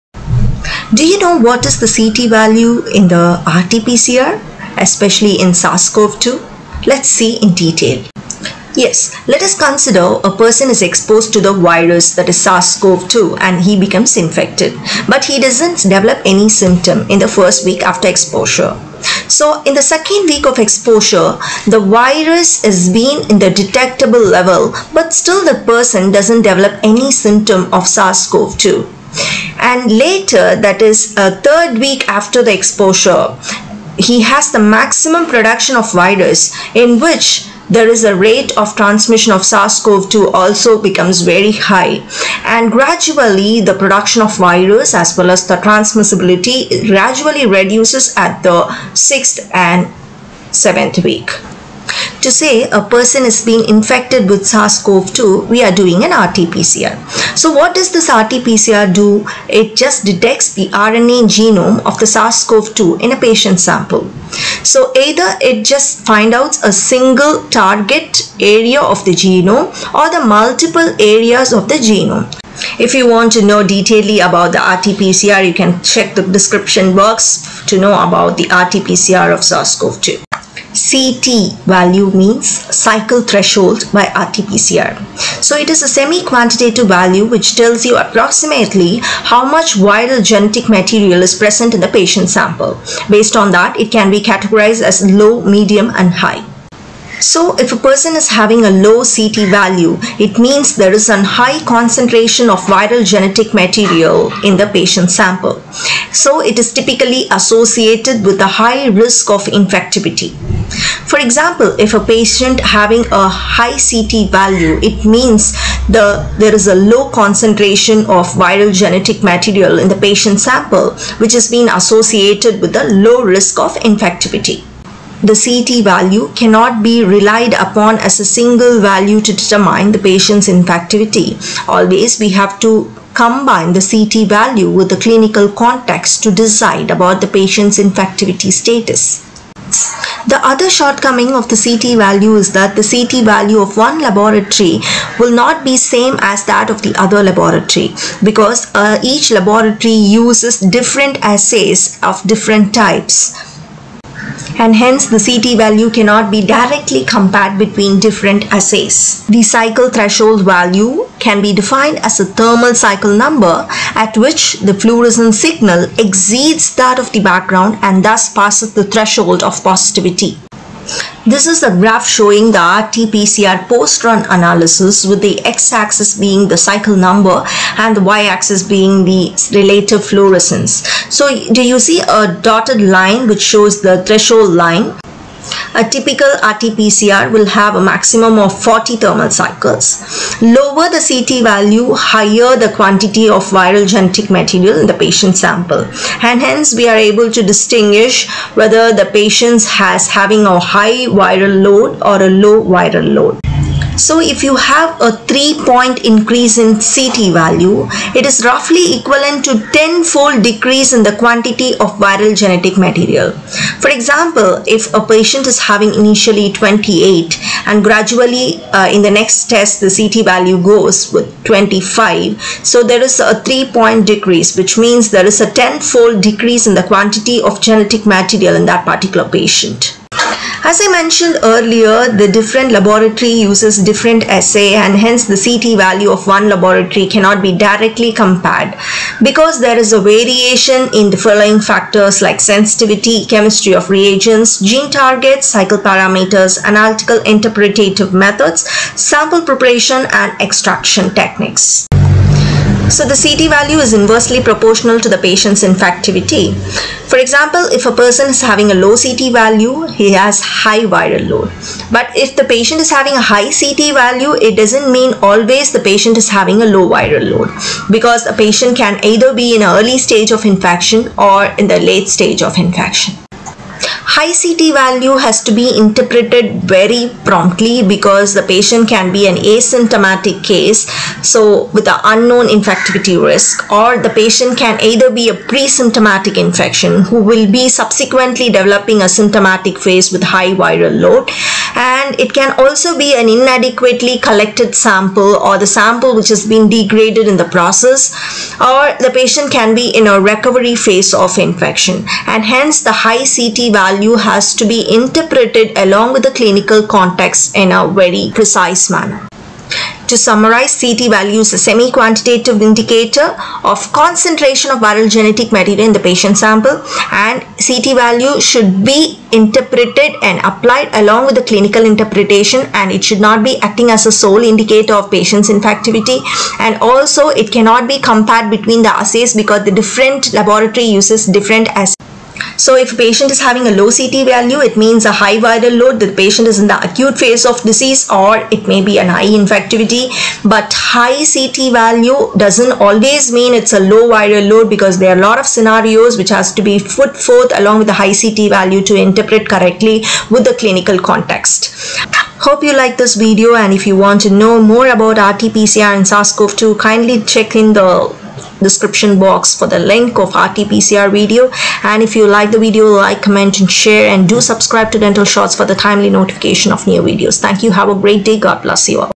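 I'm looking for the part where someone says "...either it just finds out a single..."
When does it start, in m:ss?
1:04.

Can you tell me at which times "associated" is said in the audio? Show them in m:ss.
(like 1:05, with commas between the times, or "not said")
1:47, 2:01.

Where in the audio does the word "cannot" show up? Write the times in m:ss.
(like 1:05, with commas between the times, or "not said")
2:06, 2:35, 3:57, 5:27.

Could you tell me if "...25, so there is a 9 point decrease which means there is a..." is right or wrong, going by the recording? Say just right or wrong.
wrong.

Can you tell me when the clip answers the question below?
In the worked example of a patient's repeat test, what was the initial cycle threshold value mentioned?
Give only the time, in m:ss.
3:36.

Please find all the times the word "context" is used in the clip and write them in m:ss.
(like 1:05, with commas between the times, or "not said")
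2:15, 5:06, 5:50.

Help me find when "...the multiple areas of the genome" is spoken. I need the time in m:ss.
1:10.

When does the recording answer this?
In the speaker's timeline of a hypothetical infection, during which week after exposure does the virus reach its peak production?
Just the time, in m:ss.
0:31.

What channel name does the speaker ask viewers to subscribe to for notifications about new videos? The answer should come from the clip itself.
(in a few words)
Dental Shots.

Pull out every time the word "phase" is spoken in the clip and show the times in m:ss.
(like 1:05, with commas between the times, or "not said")
4:49, 5:00, 5:37.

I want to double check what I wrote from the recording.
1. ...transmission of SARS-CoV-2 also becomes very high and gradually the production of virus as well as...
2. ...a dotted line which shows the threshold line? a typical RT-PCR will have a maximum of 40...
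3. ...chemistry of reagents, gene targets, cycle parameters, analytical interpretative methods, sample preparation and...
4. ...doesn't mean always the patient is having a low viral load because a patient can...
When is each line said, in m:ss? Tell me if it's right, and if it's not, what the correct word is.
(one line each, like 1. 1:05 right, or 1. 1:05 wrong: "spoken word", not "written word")
1. 0:38 right
2. 3:02 right
3. 4:03 right
4. 4:24 right.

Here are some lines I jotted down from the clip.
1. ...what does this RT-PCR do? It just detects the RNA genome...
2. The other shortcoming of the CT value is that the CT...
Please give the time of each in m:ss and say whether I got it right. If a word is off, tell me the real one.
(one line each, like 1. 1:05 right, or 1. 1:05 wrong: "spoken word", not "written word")
1. 0:57 right
2. 2:20 right.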